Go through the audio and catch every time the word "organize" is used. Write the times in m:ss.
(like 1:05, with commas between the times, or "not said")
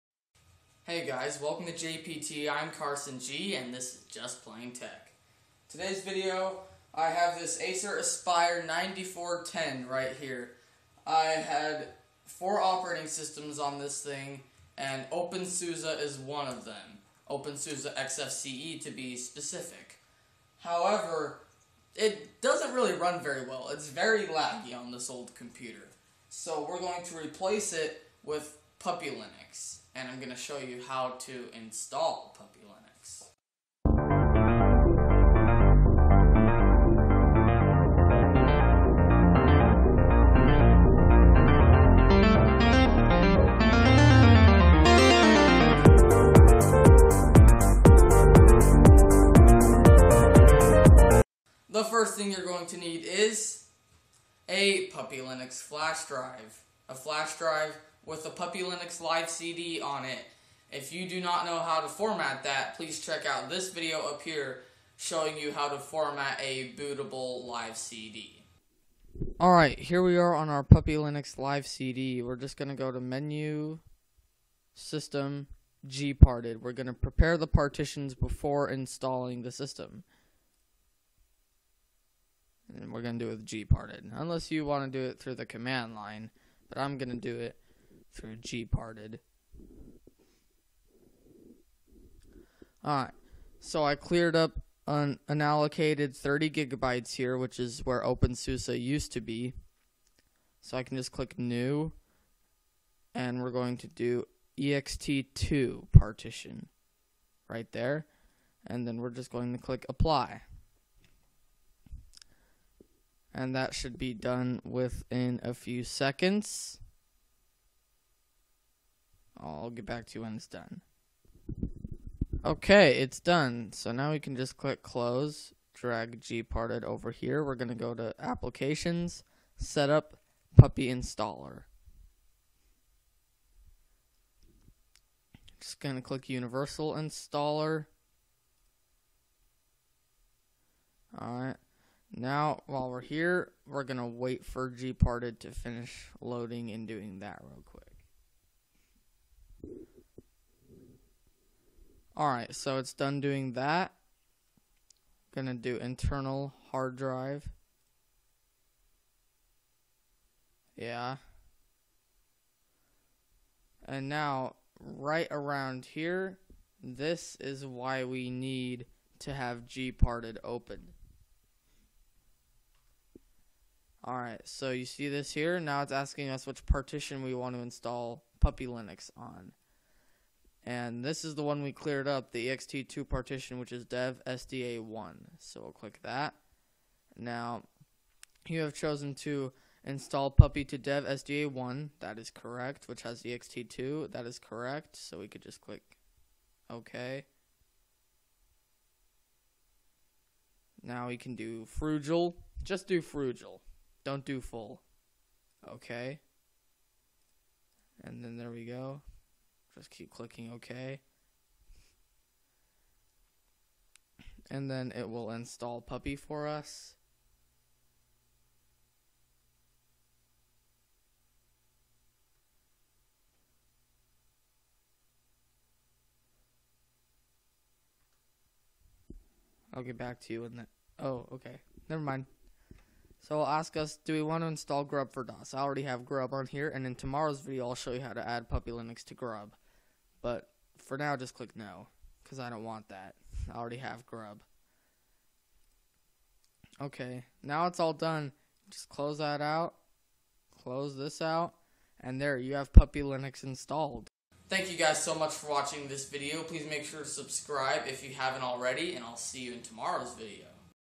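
not said.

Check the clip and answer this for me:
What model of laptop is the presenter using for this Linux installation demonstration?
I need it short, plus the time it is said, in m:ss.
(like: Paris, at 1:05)
Acer Aspire 9410, at 0:07.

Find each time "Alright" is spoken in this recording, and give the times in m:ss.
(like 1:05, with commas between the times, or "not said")
1:09, 1:32, 2:32, 2:54.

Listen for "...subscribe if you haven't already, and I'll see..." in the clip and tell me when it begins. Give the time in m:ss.
4:17.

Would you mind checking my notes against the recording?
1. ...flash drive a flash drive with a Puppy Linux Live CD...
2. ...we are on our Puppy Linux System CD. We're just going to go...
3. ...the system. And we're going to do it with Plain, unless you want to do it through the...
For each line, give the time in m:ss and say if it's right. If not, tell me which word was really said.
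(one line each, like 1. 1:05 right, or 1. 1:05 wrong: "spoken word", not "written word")
1. 0:55 right
2. 1:10 wrong: "Live", not "System"
3. 1:19 wrong: "Gparted", not "Plain".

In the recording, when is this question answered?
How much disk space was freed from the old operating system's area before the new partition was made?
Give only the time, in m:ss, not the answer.
1:36.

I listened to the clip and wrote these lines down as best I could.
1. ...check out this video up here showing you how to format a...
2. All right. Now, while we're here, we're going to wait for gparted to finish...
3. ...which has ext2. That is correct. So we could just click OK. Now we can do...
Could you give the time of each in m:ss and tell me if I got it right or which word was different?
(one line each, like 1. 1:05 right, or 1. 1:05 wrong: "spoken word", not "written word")
1. 1:03 right
2. 2:21 right
3. 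3:12 right.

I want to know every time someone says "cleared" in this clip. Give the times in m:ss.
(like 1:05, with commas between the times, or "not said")
1:33, 3:01.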